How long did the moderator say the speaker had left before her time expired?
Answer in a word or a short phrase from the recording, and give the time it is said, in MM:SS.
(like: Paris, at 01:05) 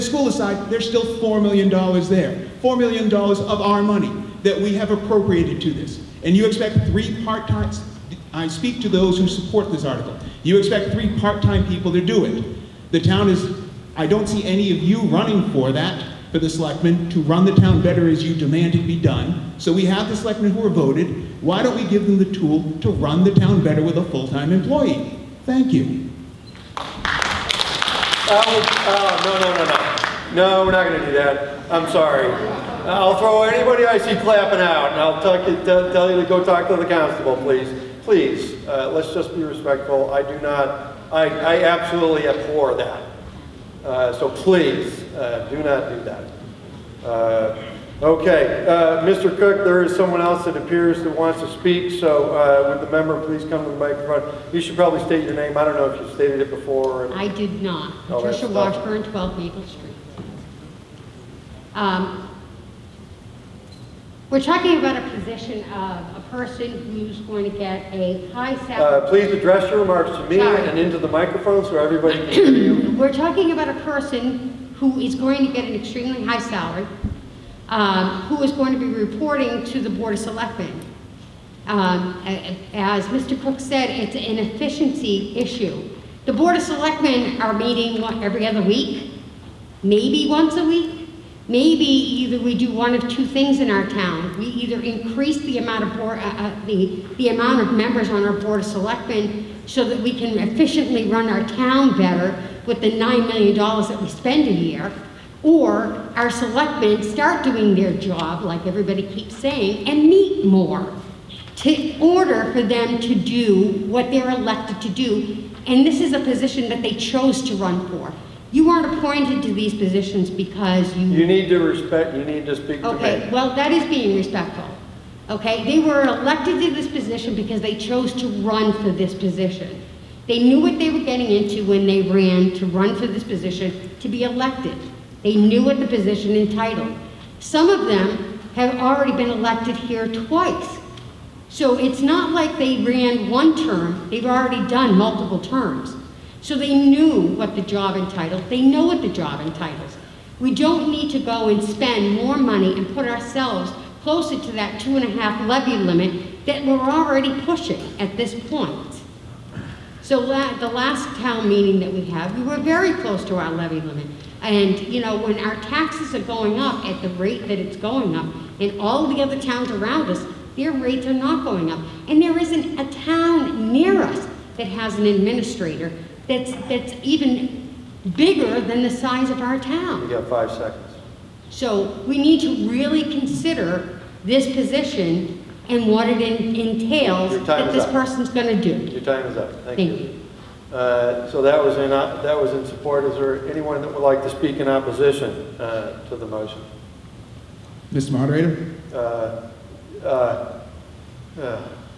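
5 seconds, at 03:00.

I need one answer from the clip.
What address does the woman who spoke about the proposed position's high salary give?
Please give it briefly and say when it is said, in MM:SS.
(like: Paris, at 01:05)
12 Maple Street, at 00:59.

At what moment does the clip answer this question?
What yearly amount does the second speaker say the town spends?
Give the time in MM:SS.
01:42.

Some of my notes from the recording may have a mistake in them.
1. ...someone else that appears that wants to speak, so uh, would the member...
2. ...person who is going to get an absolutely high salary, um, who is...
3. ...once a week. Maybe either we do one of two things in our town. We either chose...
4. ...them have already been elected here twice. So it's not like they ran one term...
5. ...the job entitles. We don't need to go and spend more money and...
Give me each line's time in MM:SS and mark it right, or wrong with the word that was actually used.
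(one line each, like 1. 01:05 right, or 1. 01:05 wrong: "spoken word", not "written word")
1. 00:49 right
2. 01:13 wrong: "extremely", not "absolutely"
3. 01:30 wrong: "increase", not "chose"
4. 02:17 right
5. 02:29 right.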